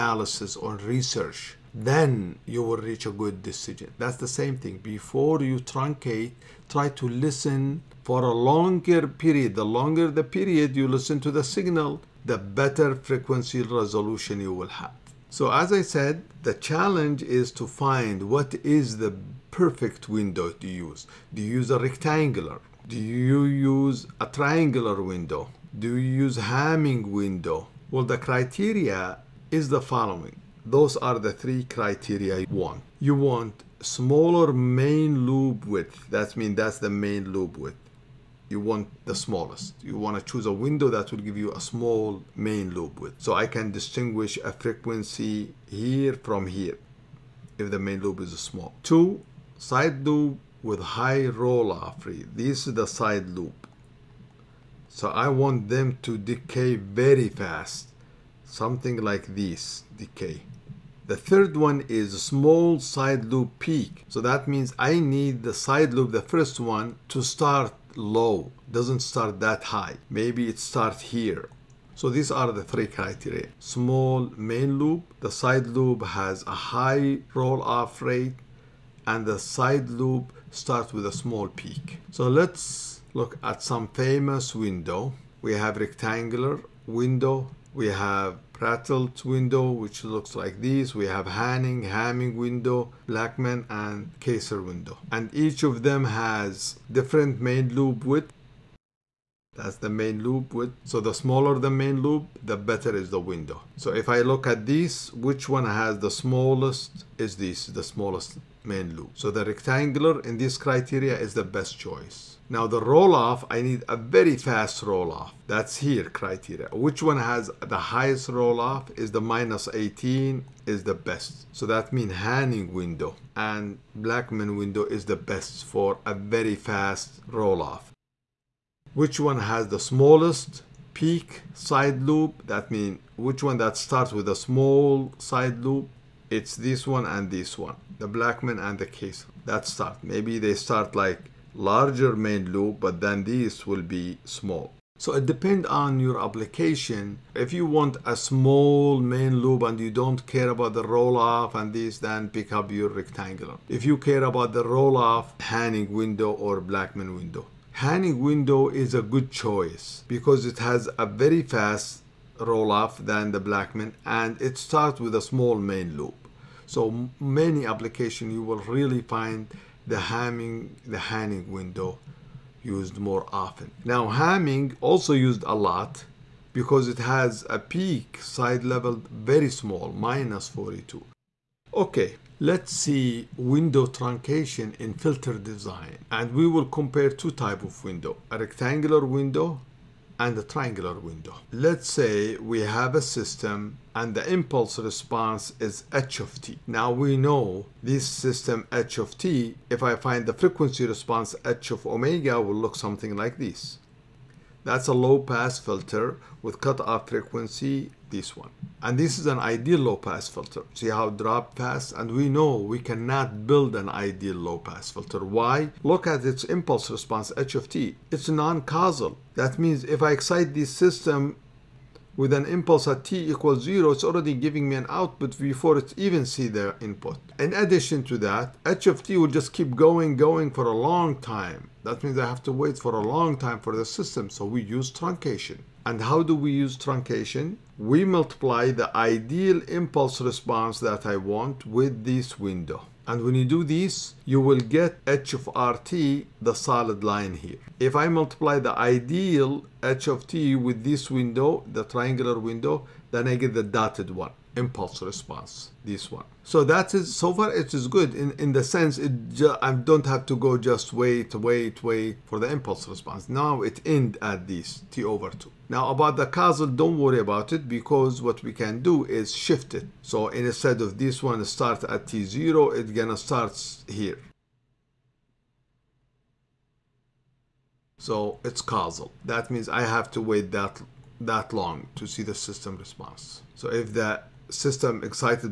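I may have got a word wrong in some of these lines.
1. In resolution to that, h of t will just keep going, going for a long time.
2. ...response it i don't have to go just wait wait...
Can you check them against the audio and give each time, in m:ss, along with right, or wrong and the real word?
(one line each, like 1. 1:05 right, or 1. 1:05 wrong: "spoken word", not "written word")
1. 3:47 wrong: "addition", not "resolution"
2. 4:18 wrong: "sense", not "response".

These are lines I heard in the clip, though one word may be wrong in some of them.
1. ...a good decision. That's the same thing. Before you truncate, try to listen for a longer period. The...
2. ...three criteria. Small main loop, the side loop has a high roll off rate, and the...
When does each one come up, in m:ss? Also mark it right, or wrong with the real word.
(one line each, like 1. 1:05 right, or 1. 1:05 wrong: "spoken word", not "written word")
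1. 0:03 right
2. 1:12 right.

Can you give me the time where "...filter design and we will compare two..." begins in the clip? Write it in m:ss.
3:04.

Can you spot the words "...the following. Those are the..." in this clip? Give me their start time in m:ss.
0:29.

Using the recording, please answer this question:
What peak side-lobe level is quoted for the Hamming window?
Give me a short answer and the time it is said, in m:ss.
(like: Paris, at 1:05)
-42, at 2:59.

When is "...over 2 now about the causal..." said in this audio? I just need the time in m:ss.
4:25.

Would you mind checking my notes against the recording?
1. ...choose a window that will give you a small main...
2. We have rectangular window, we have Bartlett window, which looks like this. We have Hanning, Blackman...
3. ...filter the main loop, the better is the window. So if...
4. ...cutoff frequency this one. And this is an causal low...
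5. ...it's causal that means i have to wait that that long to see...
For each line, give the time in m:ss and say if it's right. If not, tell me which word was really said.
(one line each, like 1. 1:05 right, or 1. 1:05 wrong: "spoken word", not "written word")
1. 0:40 right
2. 1:25 wrong: "Hamming", not "Blackman"
3. 1:41 wrong: "smaller", not "filter"
4. 3:26 wrong: "ideal", not "causal"
5. 4:38 right.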